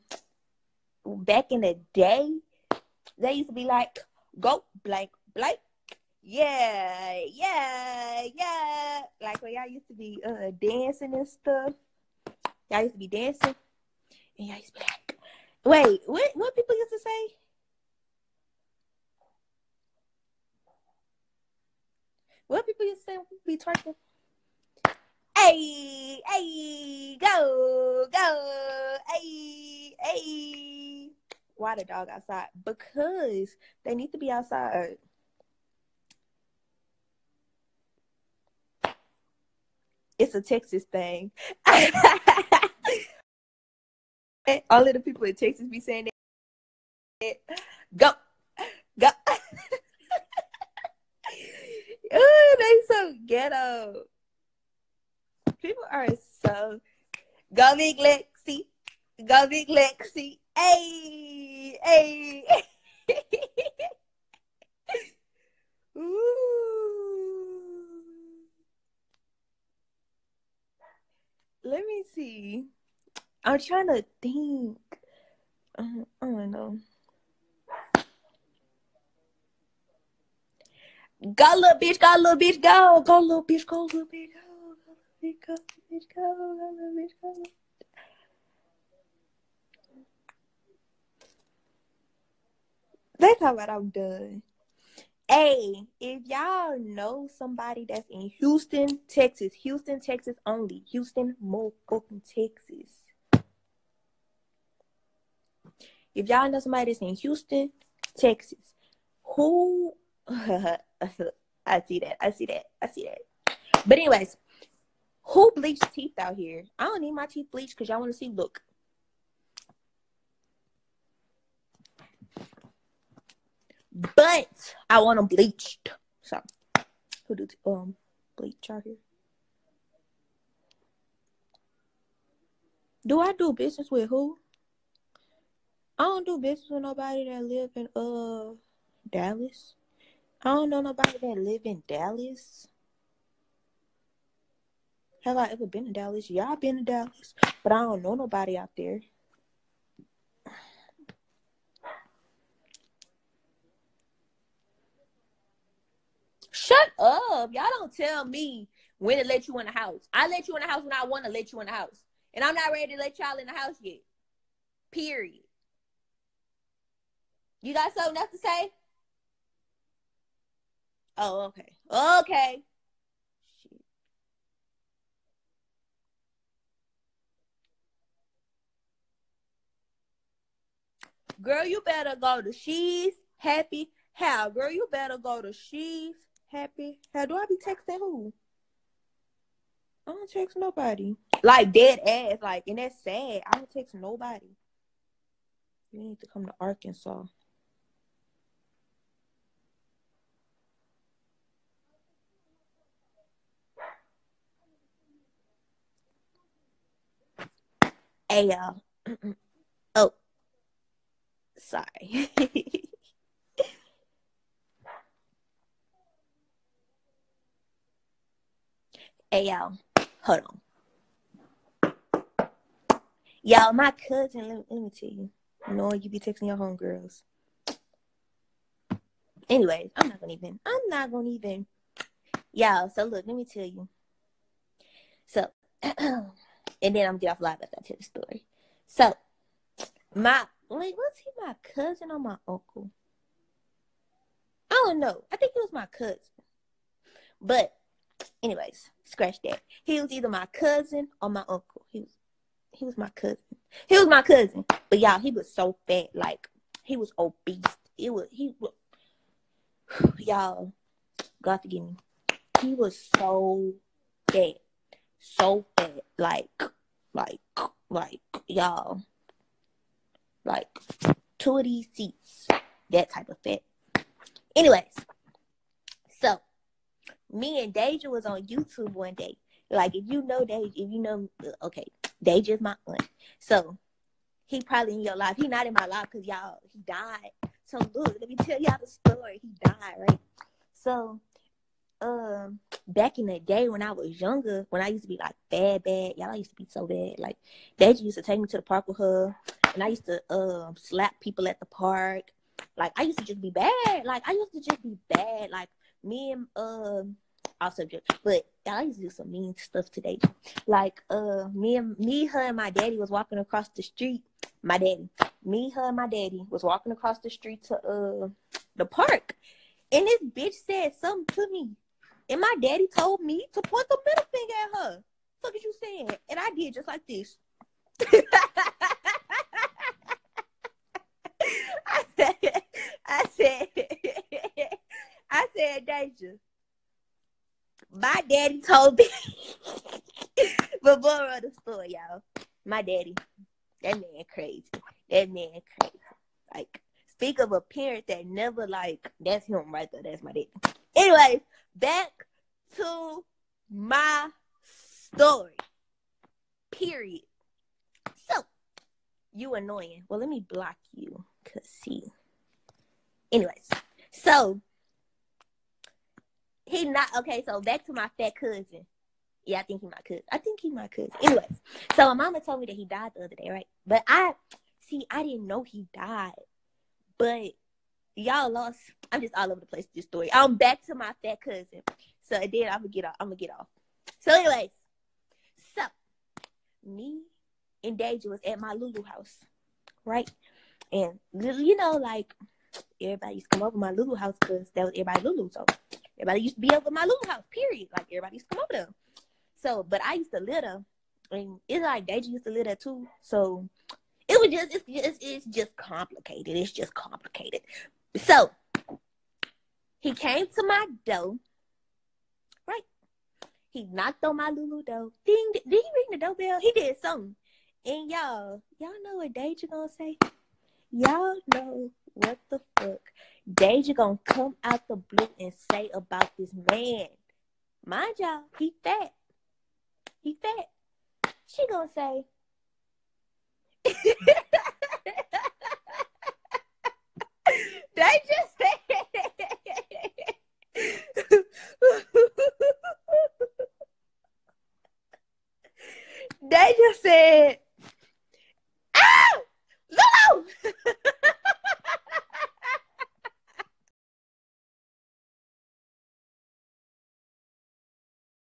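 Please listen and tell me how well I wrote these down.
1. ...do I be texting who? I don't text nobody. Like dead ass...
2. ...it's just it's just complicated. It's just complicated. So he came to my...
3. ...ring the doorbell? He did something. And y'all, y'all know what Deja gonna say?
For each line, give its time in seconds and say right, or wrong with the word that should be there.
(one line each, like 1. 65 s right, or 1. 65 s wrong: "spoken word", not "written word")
1. 187 s right
2. 404 s right
3. 415 s right.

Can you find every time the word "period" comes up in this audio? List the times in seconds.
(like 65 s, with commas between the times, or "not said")
164 s, 356 s, 397 s.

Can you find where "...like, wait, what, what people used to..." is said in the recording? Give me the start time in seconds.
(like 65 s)
14 s.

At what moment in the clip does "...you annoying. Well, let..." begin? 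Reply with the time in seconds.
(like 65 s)
359 s.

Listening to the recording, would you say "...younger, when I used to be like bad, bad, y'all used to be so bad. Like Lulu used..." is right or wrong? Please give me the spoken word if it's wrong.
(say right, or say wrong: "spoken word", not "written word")
wrong: "Deja", not "Lulu".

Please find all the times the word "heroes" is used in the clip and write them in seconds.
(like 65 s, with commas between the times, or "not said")
not said.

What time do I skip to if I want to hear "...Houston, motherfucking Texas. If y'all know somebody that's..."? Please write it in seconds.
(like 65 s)
100 s.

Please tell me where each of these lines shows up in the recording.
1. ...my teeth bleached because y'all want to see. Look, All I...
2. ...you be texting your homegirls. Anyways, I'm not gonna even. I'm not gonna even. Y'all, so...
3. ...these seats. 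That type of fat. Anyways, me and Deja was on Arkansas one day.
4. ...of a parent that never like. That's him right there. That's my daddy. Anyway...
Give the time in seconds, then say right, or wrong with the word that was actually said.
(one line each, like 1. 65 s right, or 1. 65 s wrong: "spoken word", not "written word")
1. 117 s wrong: "But", not "All"
2. 225 s right
3. 271 s wrong: "YouTube", not "Arkansas"
4. 347 s right.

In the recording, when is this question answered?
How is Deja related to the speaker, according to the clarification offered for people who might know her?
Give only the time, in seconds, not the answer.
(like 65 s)
282 s.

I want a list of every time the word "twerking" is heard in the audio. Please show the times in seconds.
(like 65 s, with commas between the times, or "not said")
23 s.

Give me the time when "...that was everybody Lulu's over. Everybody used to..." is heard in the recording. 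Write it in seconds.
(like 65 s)
394 s.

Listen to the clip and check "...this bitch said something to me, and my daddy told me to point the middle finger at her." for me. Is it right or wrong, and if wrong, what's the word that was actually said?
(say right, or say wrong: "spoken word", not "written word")
right.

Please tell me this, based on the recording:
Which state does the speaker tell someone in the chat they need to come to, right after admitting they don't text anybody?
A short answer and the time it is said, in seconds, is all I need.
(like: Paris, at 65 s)
Arkansas, at 196 s.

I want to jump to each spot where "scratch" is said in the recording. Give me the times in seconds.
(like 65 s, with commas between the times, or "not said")
249 s.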